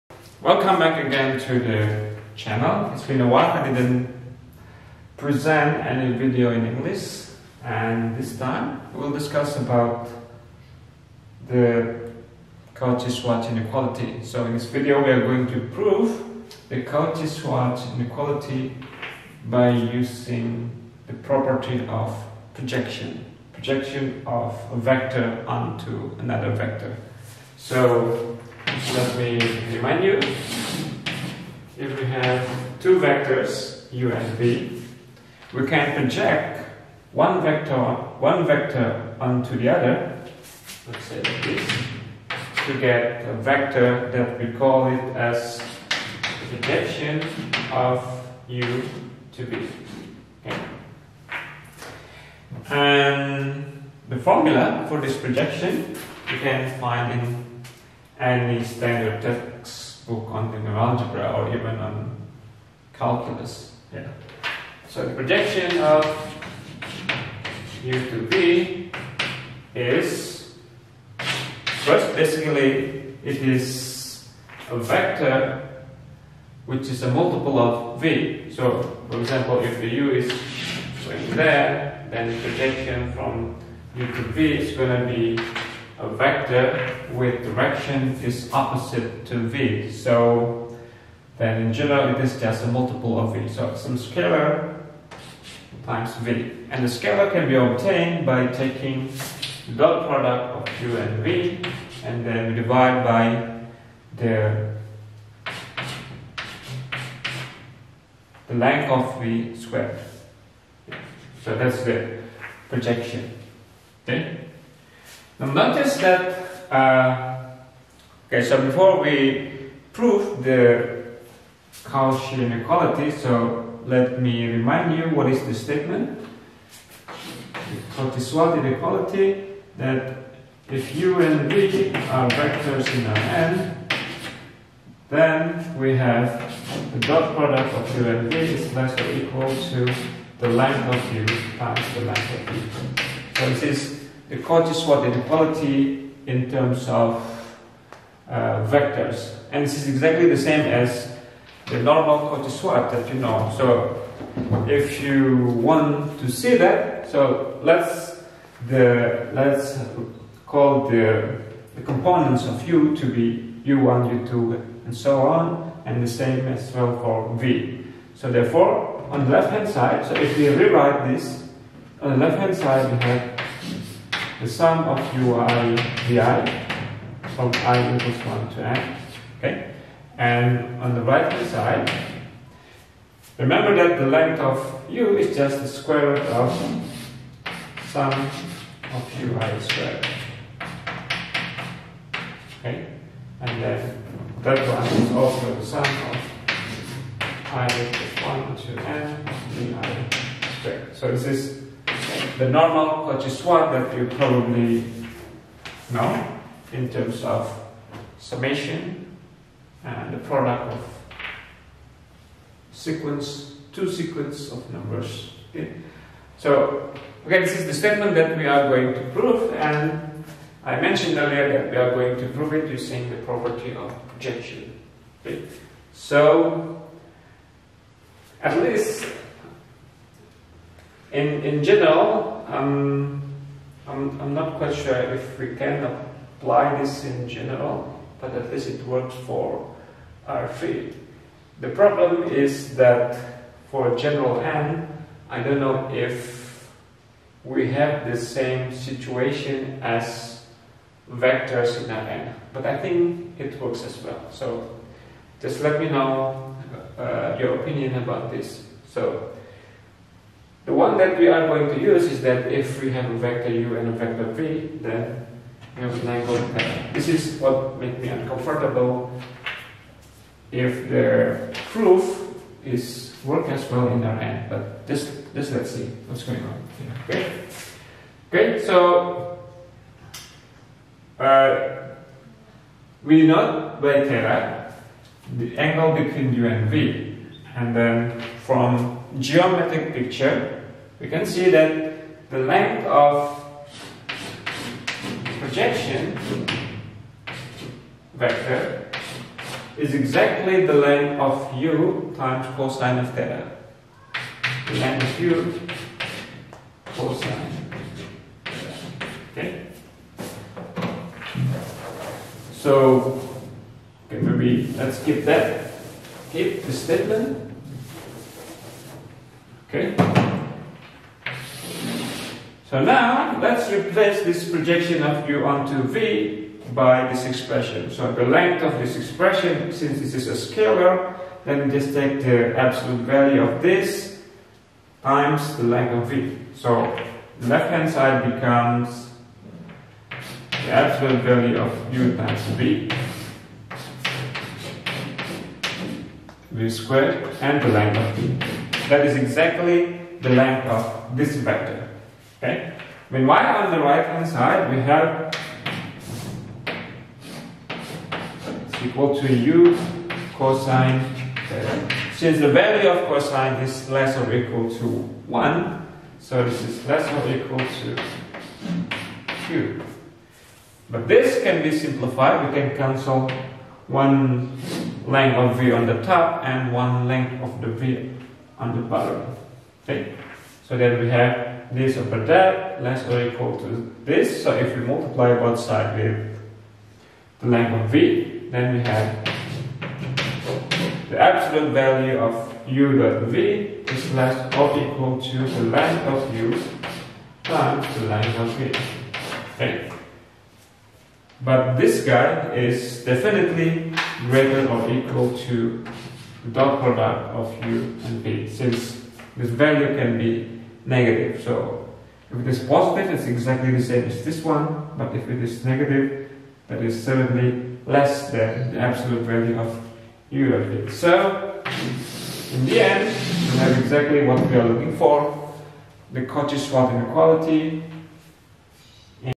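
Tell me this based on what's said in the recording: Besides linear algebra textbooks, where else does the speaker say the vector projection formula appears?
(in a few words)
Calculus.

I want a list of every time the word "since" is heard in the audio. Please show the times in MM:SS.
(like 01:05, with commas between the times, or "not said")
05:29, 06:02, 06:48.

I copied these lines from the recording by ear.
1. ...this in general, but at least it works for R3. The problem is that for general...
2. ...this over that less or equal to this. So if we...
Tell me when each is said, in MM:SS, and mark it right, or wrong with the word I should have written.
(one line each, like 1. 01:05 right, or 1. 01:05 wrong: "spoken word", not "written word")
1. 03:56 right
2. 06:21 right.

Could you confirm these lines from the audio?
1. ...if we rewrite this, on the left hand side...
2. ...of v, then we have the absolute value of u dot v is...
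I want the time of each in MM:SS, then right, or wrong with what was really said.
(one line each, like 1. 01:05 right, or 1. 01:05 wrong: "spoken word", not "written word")
1. 02:50 right
2. 06:27 right.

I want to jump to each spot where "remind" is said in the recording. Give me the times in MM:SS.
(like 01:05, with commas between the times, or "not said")
00:29, 02:04.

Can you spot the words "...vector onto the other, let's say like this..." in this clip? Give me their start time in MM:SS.
00:38.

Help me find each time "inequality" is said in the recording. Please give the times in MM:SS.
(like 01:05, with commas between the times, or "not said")
00:13, 00:17, 02:02, 02:08, 02:25, 07:06.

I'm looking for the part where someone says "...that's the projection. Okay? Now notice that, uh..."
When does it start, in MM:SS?
01:51.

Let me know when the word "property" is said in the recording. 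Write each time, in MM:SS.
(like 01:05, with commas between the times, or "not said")
00:21, 03:43.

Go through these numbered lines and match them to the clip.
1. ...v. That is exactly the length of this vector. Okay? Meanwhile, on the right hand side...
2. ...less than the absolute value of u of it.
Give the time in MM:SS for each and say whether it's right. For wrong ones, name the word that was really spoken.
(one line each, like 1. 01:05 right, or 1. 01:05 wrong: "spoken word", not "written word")
1. 05:48 right
2. 06:57 right.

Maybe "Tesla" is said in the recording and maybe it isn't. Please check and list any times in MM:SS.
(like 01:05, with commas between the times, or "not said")
not said.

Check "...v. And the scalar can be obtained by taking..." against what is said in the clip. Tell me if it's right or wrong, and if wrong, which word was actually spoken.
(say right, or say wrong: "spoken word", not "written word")
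right.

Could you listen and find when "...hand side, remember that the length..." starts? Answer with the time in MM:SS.
03:01.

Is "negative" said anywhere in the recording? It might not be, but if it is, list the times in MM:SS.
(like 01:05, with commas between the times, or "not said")
06:50, 06:55.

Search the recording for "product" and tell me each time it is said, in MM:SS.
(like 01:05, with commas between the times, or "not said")
01:40, 02:17, 03:30, 06:46.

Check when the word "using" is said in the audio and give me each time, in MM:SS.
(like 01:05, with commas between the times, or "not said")
00:19, 03:42.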